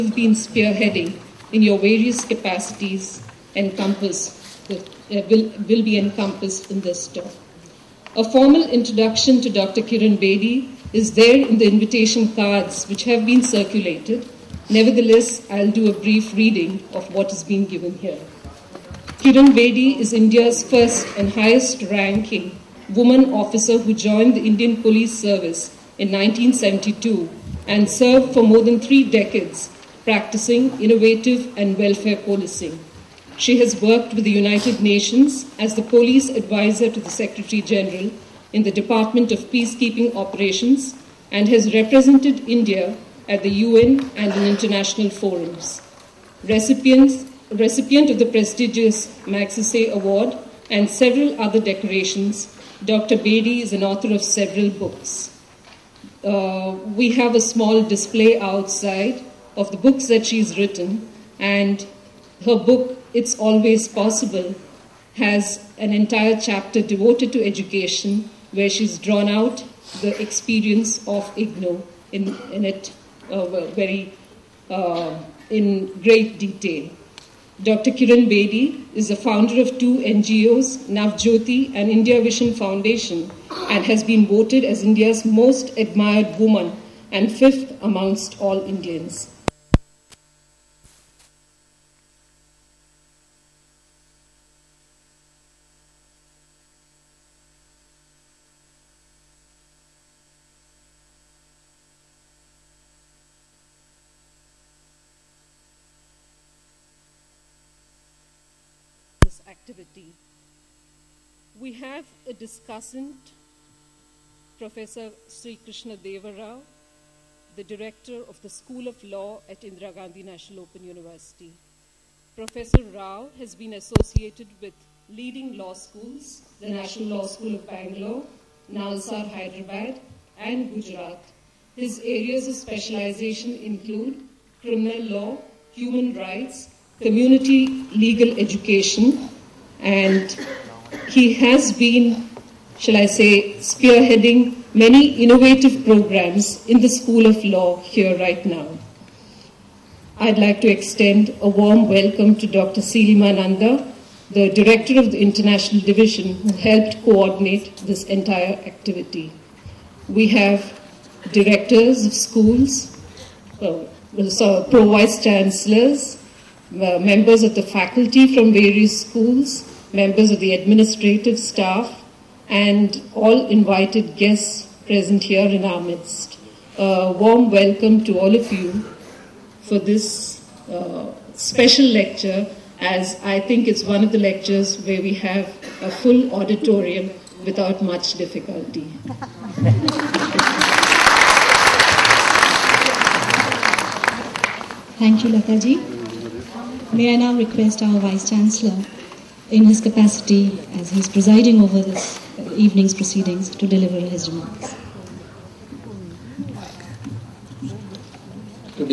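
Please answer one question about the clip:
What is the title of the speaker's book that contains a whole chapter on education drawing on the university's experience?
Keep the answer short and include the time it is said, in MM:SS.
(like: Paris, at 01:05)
It's Always Possible, at 01:03.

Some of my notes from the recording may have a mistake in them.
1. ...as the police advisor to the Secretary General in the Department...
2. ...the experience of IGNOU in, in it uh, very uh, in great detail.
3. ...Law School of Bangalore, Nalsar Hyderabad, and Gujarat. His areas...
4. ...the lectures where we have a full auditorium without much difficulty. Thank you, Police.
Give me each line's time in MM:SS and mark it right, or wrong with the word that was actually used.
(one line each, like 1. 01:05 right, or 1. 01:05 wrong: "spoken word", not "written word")
1. 00:35 right
2. 01:10 right
3. 02:07 right
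4. 03:04 wrong: "Lataji", not "Police".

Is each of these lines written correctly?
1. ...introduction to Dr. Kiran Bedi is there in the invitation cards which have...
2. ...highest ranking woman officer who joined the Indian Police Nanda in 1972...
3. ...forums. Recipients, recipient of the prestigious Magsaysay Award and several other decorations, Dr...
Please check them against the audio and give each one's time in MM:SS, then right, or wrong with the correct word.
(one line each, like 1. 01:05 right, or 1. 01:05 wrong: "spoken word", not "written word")
1. 00:08 right
2. 00:21 wrong: "Service", not "Nanda"
3. 00:45 right.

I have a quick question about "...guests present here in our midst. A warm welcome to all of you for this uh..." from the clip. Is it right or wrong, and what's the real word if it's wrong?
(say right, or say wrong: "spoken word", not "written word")
right.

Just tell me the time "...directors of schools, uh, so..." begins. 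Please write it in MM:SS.
02:41.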